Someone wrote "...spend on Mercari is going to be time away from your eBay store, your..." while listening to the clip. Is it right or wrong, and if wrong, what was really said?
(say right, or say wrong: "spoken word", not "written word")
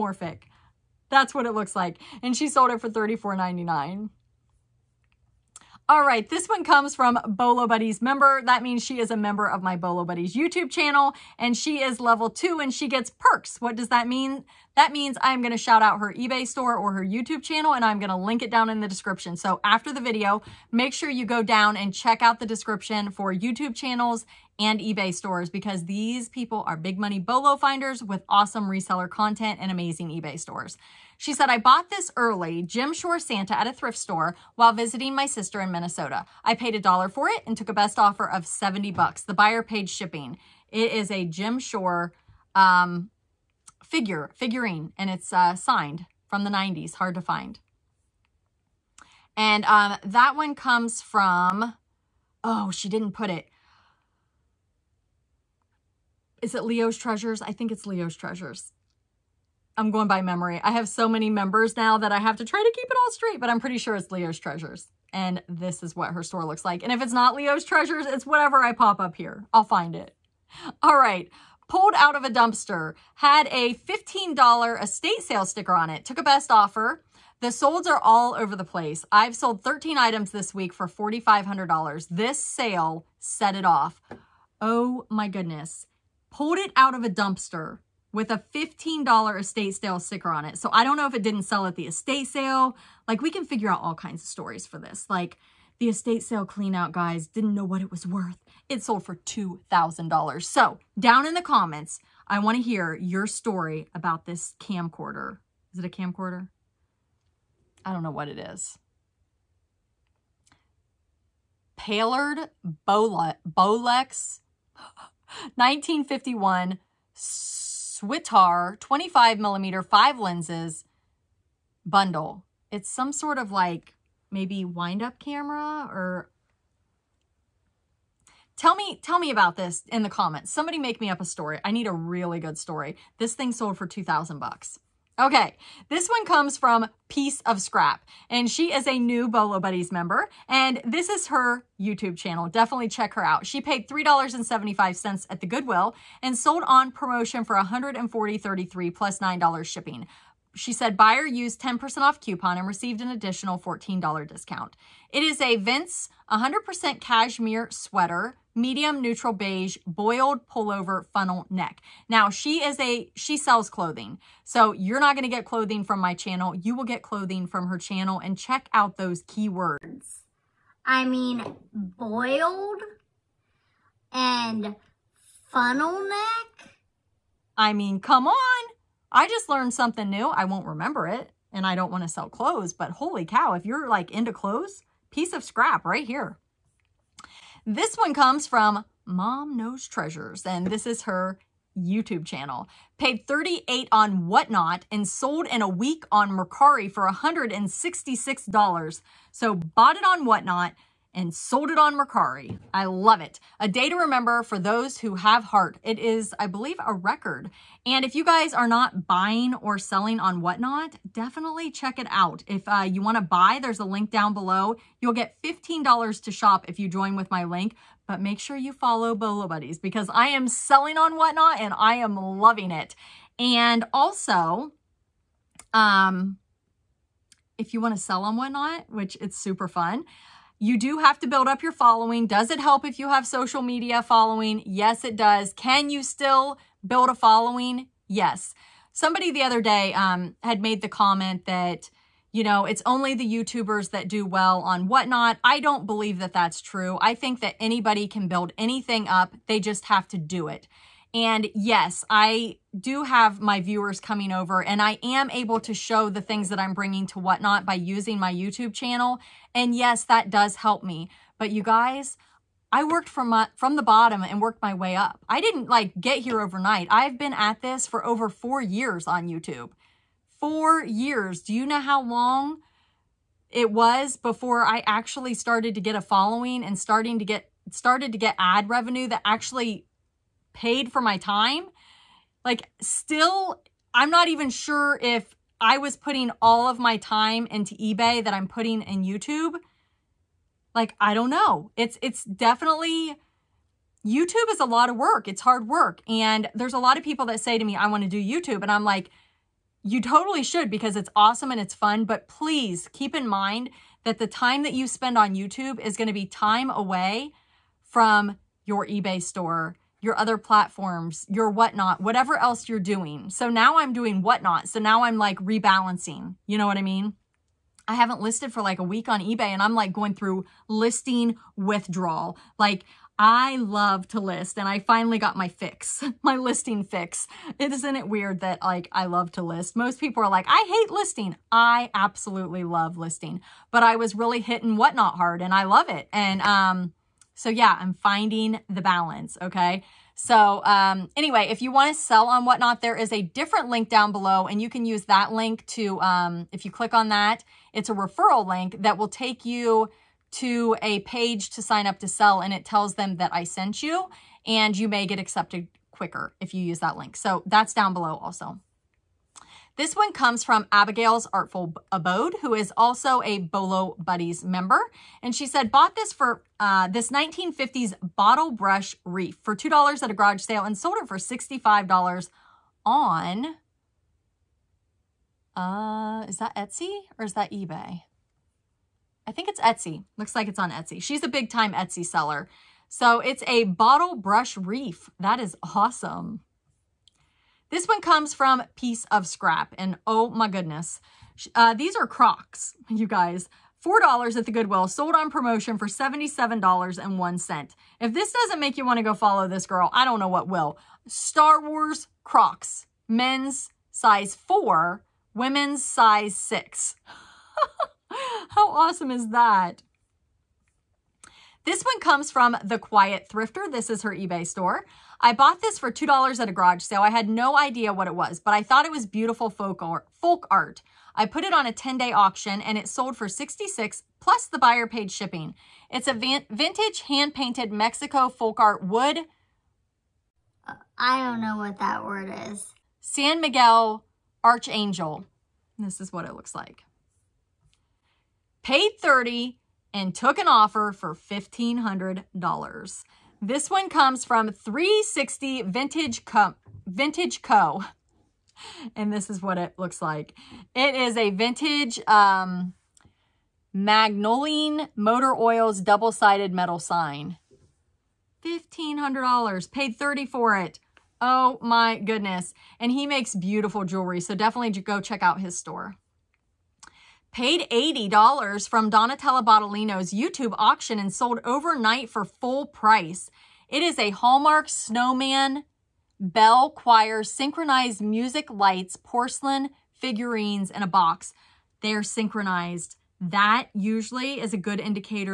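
wrong: "YouTube", not "Mercari".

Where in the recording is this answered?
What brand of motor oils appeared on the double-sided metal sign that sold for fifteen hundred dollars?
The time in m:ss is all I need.
7:33.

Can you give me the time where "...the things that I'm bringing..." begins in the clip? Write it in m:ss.
4:16.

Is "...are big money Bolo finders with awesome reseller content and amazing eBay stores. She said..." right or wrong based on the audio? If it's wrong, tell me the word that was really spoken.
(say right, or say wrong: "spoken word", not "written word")
right.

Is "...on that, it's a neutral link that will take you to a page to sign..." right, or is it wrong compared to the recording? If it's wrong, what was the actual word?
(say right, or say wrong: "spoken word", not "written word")
wrong: "referral", not "neutral".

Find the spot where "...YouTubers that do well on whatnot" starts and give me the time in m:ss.
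4:03.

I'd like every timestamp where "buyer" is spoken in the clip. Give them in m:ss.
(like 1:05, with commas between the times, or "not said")
0:39, 2:30, 7:04.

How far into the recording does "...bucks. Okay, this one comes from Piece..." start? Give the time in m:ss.
2:14.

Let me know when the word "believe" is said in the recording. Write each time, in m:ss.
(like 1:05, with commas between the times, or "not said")
3:26, 4:05.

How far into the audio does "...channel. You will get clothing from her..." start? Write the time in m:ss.
2:46.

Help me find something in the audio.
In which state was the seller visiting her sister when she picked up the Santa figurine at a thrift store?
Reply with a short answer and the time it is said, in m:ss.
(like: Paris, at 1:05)
Minnesota, at 0:35.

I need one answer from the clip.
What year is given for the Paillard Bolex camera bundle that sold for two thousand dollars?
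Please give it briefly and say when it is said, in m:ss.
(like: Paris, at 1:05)
1951, at 1:55.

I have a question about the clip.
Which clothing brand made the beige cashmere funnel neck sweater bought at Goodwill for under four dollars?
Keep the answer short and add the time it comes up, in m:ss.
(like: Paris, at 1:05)
Vince, at 2:35.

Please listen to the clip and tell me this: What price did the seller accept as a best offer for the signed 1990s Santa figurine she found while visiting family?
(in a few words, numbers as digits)
$70.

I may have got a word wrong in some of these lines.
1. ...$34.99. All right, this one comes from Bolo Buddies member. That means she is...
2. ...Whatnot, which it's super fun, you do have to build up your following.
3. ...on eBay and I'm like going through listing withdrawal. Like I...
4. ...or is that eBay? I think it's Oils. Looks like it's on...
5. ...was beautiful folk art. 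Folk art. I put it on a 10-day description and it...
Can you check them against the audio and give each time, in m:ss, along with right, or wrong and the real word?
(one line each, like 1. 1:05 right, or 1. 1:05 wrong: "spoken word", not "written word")
1. 0:02 right
2. 3:48 right
3. 5:19 right
4. 6:17 wrong: "Etsy", not "Oils"
5. 6:58 wrong: "auction", not "description".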